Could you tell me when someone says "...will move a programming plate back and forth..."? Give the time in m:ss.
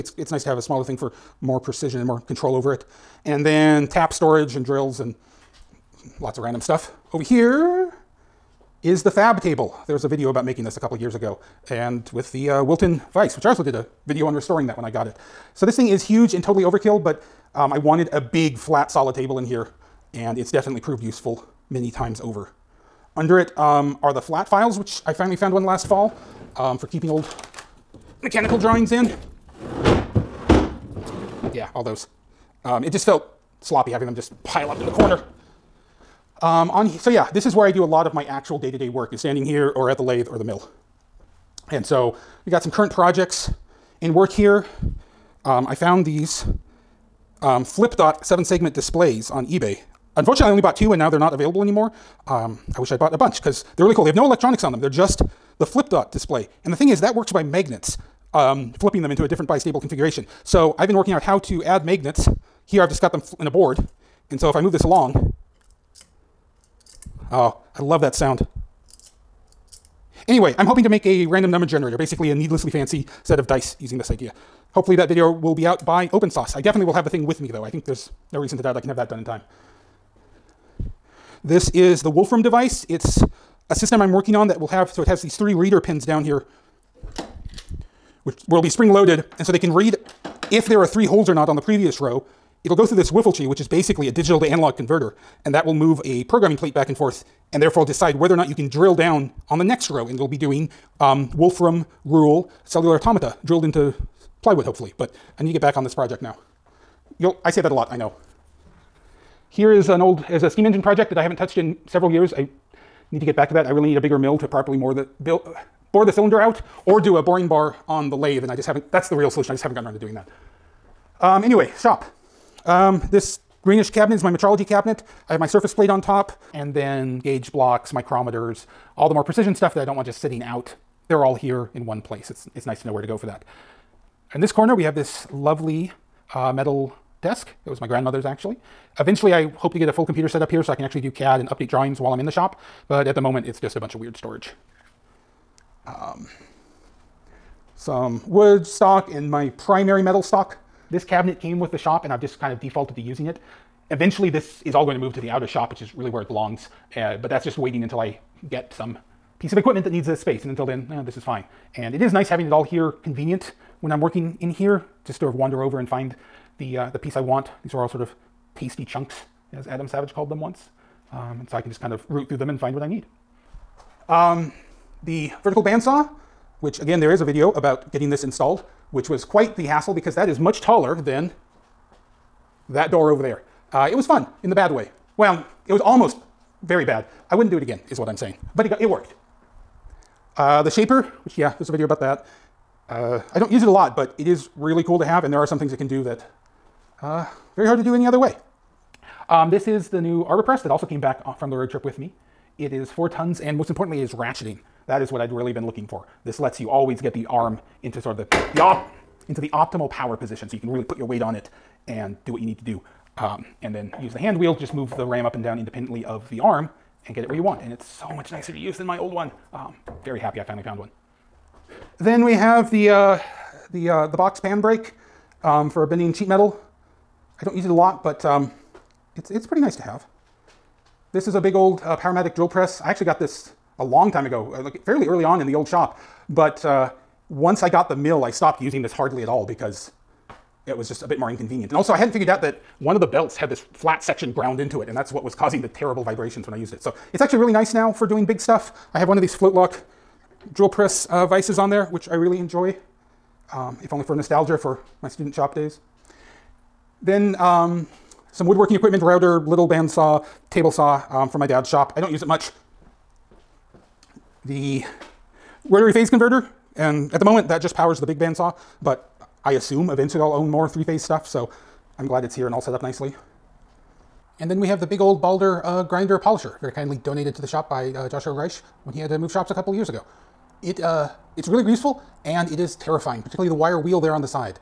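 1:35.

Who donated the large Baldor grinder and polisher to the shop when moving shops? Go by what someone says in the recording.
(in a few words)
Joshua Reich.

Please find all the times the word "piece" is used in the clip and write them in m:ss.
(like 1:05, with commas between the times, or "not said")
2:39, 2:46.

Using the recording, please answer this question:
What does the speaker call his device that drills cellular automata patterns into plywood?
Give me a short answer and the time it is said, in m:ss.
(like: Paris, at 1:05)
Wolfram device, at 1:22.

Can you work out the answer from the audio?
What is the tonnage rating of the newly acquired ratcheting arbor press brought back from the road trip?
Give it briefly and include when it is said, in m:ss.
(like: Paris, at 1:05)
4 tons, at 3:22.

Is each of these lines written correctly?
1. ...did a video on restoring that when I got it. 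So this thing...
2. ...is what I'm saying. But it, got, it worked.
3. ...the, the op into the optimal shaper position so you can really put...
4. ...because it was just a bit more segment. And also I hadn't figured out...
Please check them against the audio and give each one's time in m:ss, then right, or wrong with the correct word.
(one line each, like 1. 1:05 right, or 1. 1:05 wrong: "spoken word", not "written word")
1. 0:13 right
2. 3:07 right
3. 3:28 wrong: "power", not "shaper"
4. 3:59 wrong: "inconvenient", not "segment".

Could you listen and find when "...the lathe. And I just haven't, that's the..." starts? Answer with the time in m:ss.
1:58.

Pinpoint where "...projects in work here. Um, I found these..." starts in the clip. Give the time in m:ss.
0:42.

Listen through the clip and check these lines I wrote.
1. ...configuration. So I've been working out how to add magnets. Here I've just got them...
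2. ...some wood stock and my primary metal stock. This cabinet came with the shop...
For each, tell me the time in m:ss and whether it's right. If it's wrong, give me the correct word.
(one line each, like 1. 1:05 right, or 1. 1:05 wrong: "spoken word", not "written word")
1. 0:59 right
2. 2:27 right.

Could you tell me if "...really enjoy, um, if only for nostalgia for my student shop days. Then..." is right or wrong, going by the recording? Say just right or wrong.
right.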